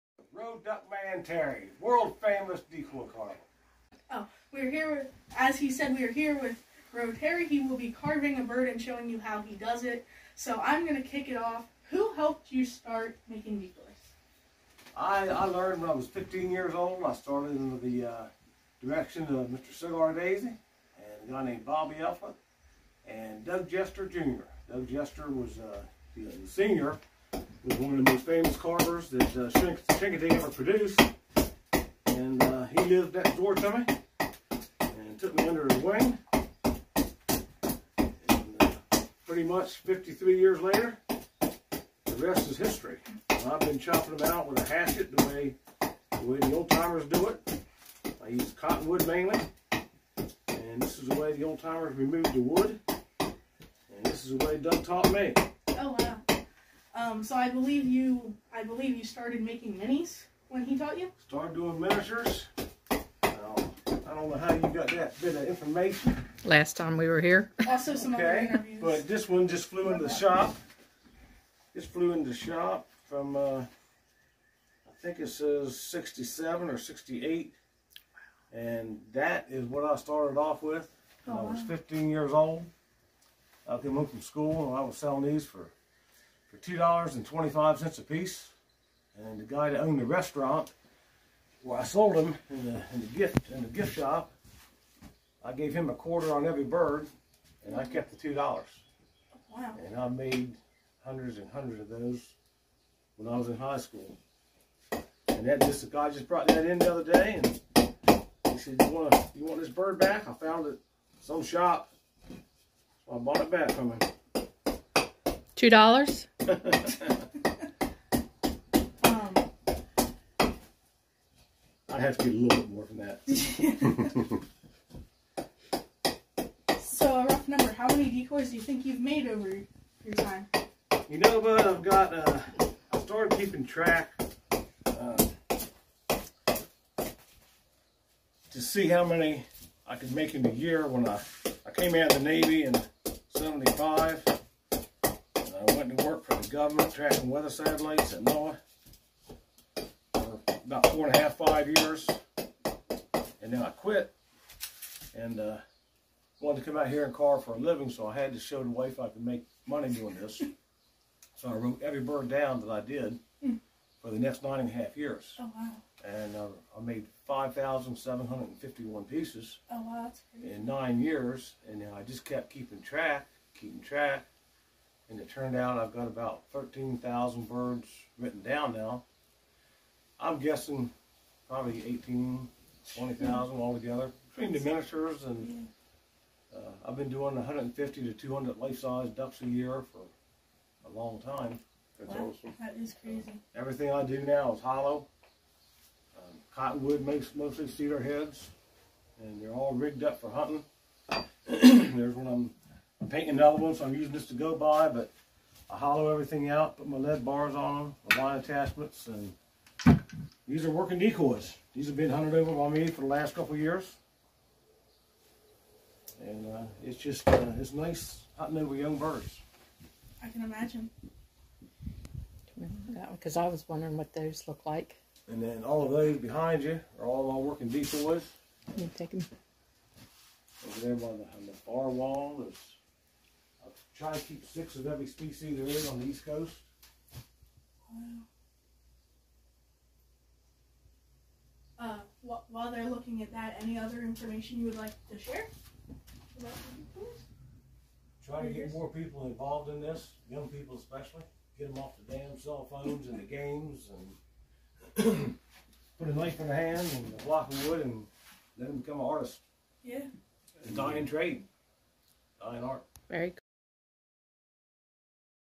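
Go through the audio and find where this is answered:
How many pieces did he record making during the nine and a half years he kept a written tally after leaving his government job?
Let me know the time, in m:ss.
2:47.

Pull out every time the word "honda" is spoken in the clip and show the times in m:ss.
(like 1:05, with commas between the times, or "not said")
not said.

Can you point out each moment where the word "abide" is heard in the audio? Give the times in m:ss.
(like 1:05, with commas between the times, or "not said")
not said.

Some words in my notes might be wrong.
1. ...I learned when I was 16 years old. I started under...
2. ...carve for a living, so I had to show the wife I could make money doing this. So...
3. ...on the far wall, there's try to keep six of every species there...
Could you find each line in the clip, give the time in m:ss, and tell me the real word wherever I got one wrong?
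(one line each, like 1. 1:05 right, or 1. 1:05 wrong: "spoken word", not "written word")
1. 0:15 wrong: "15", not "16"
2. 2:37 right
3. 3:51 right.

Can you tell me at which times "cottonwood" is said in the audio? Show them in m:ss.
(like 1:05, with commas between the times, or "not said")
0:48, 3:16.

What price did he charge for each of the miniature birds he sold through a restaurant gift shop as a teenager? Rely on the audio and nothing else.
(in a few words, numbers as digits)
$2.25.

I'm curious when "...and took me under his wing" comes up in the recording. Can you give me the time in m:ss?
0:34.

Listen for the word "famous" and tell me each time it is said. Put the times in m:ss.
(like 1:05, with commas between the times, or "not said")
0:02, 0:28.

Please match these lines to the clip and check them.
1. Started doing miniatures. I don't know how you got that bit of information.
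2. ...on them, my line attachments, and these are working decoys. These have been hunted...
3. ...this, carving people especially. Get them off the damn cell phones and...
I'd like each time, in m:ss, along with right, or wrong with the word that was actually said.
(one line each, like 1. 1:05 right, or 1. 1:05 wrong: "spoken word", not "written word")
1. 1:01 right
2. 3:27 right
3. 4:09 wrong: "young", not "carving".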